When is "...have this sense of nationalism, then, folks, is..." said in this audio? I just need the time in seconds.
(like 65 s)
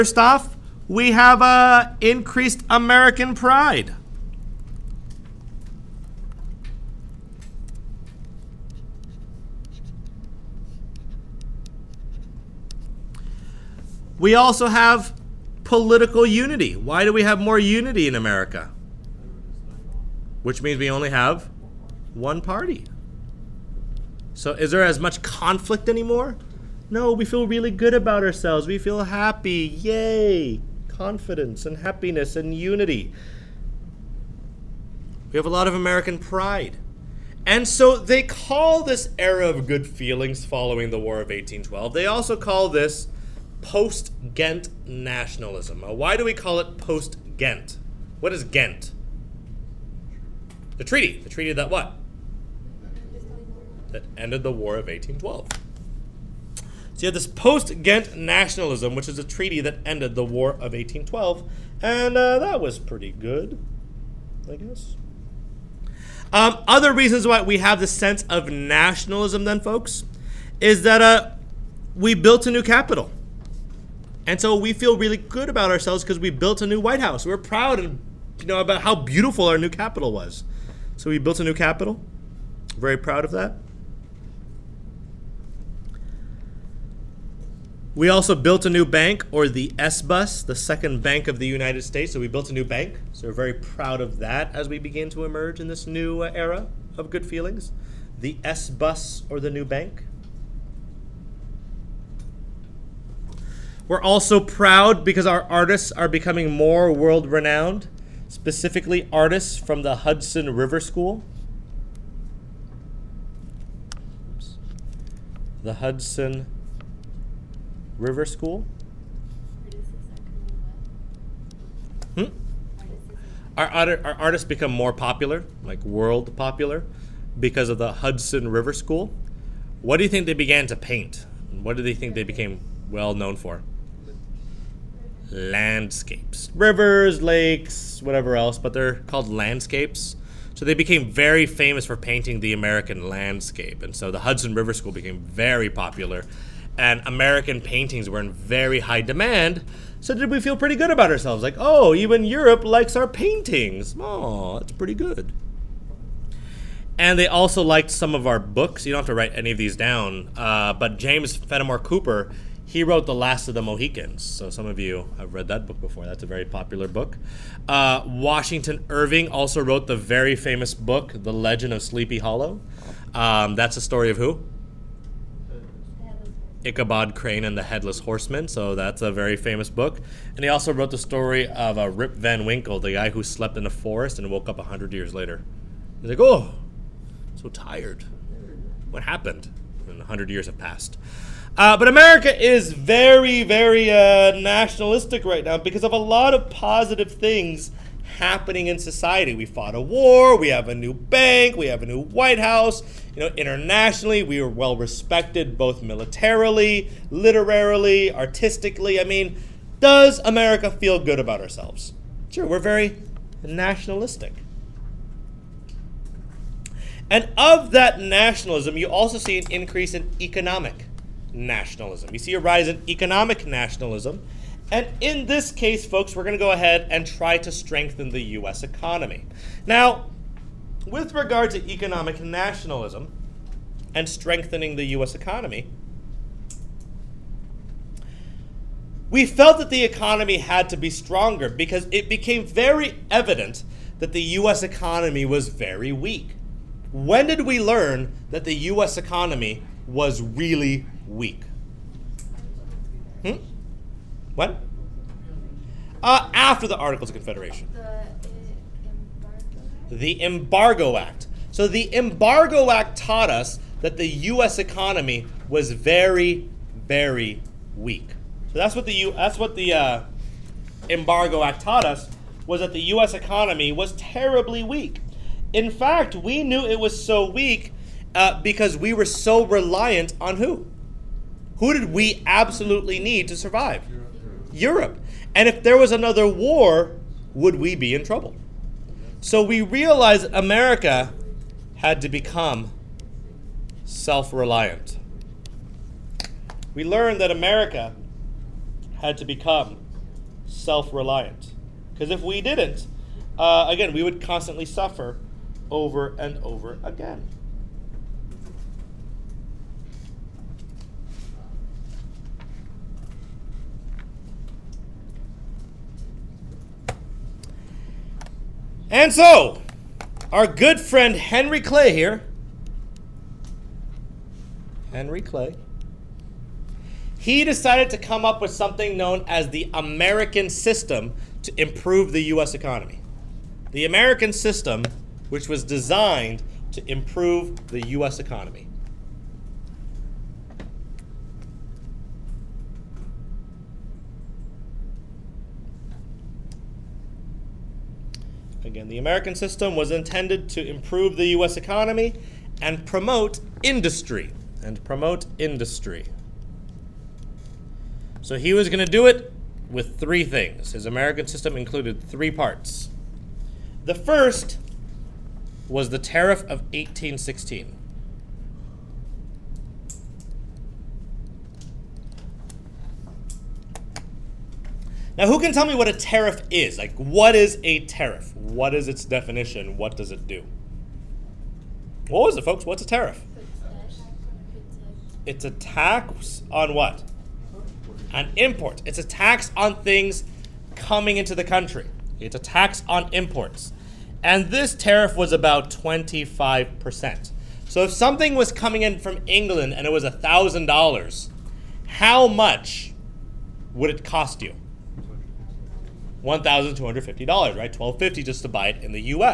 67 s.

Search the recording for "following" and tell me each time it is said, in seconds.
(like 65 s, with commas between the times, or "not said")
40 s.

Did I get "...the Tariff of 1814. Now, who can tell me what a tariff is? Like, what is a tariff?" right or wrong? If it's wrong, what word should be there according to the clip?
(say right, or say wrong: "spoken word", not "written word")
wrong: "1816", not "1814".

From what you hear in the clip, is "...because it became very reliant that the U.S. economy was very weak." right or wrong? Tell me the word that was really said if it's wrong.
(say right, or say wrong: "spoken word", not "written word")
wrong: "evident", not "reliant".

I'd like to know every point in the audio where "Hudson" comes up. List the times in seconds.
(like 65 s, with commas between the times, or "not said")
109 s, 115 s, 127 s, 144 s.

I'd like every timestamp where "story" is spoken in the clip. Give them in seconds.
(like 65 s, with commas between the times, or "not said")
173 s, 180 s.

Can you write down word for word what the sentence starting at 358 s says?
So he was going to do it with three things.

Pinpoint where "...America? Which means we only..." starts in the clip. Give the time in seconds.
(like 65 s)
18 s.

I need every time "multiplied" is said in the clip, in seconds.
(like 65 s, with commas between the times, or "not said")
not said.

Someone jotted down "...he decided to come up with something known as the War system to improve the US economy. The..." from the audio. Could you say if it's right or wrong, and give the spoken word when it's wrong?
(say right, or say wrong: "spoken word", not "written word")
wrong: "American", not "War".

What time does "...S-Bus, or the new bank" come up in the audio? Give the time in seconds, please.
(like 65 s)
98 s.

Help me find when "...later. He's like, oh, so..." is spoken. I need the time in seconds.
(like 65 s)
185 s.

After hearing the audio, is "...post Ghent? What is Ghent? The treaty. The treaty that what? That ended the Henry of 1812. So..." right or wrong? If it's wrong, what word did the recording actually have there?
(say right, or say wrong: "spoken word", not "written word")
wrong: "War", not "Henry".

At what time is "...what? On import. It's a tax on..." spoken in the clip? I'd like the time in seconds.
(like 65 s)
386 s.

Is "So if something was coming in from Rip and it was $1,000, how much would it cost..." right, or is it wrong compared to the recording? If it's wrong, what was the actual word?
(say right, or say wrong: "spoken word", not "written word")
wrong: "England", not "Rip".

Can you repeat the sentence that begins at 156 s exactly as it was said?
And they also liked some of our books.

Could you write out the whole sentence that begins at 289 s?
So we realized America had to become self reliant.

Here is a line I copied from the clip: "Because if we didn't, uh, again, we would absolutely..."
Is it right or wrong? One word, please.
wrong.